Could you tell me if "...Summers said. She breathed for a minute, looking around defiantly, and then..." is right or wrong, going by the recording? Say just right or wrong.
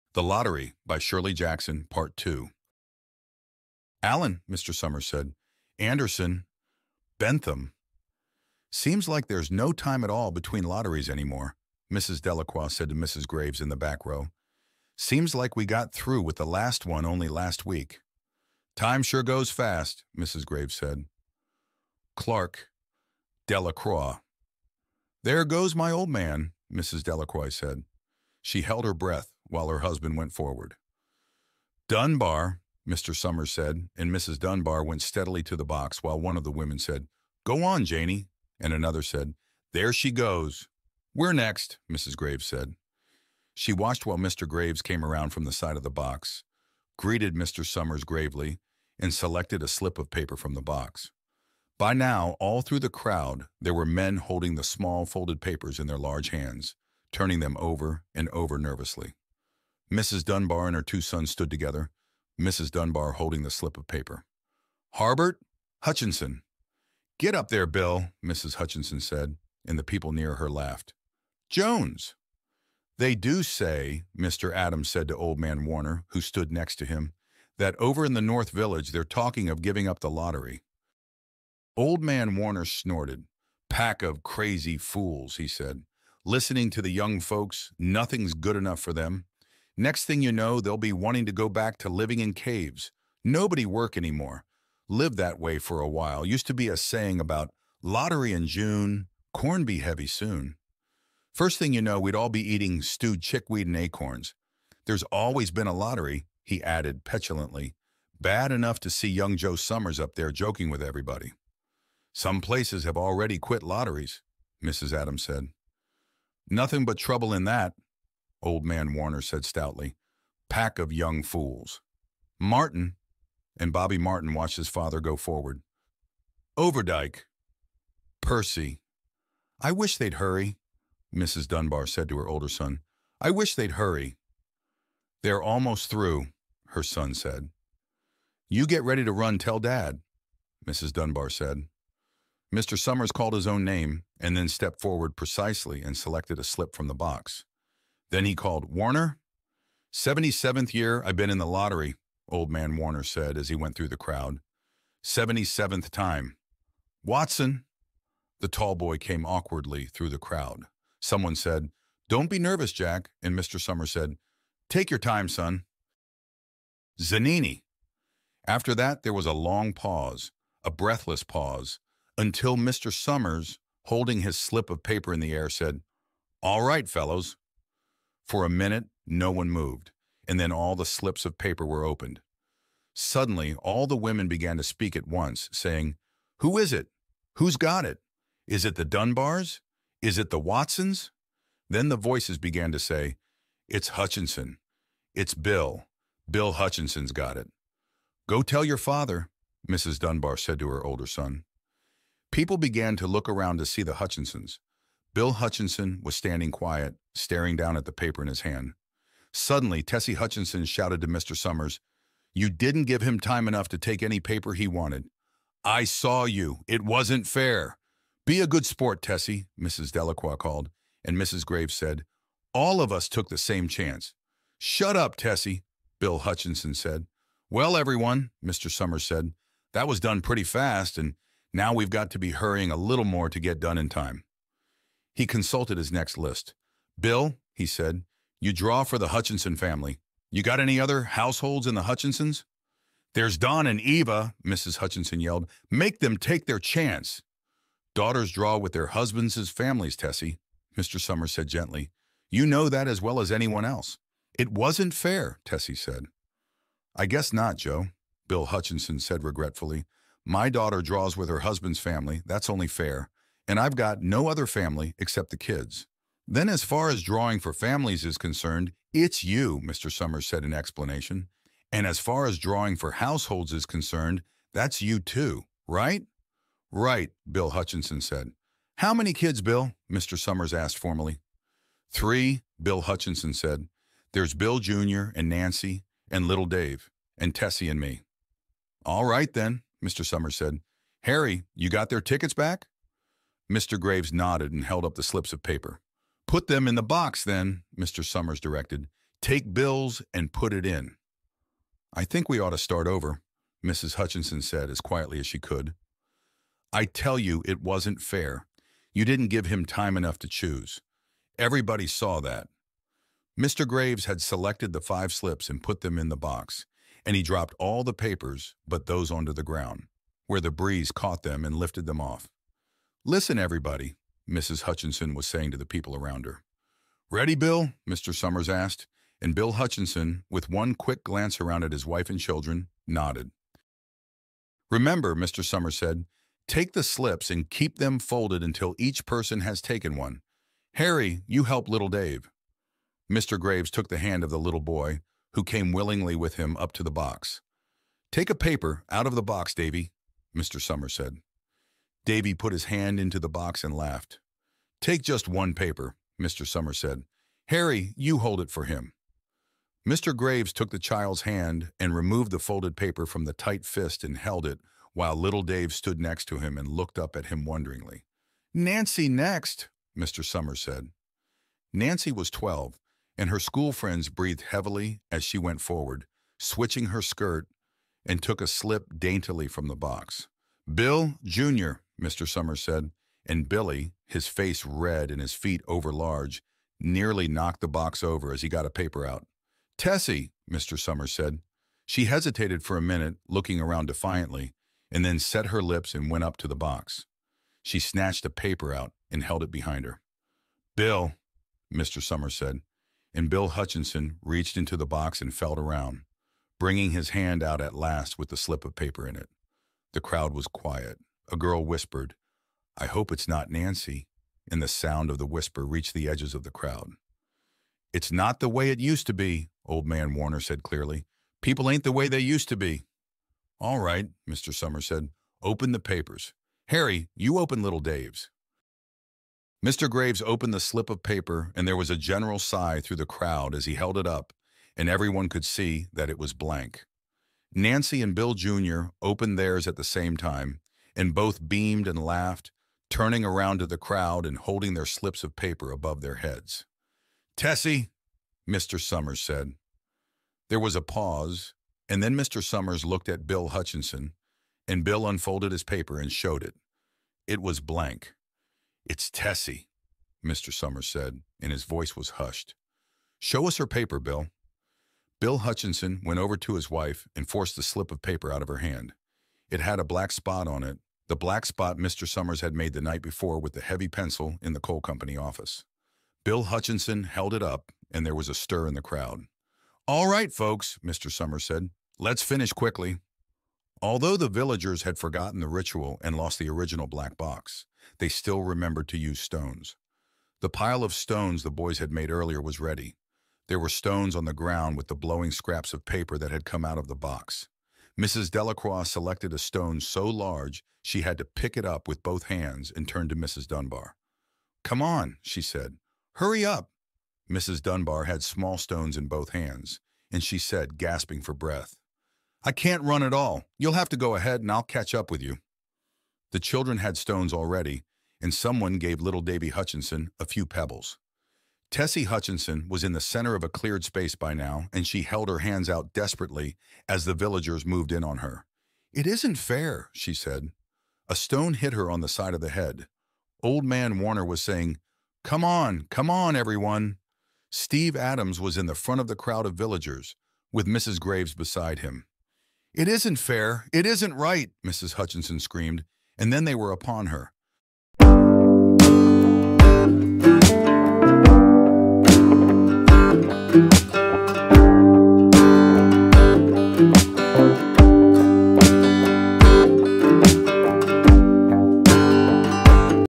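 wrong.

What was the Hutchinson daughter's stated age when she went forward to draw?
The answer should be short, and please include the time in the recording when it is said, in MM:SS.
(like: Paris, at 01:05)
12, at 06:12.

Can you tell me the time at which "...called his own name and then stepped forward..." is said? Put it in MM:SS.
02:23.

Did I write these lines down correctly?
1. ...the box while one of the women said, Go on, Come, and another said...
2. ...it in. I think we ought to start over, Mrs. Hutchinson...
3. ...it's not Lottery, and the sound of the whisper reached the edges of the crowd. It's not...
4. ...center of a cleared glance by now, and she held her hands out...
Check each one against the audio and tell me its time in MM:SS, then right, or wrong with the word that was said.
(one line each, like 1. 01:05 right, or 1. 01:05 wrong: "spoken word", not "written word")
1. 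00:35 wrong: "Janey", not "Come"
2. 05:00 right
3. 06:53 wrong: "Nancy", not "Lottery"
4. 08:42 wrong: "space", not "glance".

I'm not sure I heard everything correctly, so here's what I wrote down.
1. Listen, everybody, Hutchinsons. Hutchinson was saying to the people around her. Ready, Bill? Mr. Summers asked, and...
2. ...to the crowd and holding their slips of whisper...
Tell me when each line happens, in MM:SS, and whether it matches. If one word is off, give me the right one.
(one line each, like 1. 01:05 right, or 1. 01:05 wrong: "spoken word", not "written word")
1. 05:23 wrong: "Mrs", not "Hutchinsons"
2. 07:23 wrong: "paper", not "whisper".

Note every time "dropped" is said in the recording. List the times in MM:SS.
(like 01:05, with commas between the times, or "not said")
05:17.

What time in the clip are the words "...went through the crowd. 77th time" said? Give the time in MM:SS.
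02:33.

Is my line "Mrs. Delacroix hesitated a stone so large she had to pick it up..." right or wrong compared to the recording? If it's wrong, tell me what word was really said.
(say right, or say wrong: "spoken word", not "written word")
wrong: "selected", not "hesitated".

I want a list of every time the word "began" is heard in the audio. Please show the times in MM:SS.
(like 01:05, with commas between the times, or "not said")
03:04, 03:12, 03:22.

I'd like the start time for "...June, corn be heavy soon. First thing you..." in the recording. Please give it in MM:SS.
01:38.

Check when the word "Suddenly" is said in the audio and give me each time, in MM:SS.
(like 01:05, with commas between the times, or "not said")
03:02, 03:29.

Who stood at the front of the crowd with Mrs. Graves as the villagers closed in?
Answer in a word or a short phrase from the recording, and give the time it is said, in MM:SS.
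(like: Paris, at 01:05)
Steve Adams, at 08:57.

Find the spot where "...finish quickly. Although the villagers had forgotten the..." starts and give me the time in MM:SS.
08:02.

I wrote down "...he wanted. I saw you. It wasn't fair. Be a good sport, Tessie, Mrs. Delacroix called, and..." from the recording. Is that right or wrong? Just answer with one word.
right.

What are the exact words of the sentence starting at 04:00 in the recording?
You got any other households in the Hutchinsons?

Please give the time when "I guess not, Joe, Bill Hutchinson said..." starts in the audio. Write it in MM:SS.
04:16.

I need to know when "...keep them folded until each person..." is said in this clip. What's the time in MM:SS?
05:37.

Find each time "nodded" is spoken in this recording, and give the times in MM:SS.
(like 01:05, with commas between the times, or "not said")
04:54, 05:32.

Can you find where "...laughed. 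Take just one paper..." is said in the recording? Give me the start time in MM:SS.
05:53.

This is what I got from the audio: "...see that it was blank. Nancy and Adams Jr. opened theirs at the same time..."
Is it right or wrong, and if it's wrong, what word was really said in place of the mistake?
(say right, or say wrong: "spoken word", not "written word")
wrong: "Bill", not "Adams".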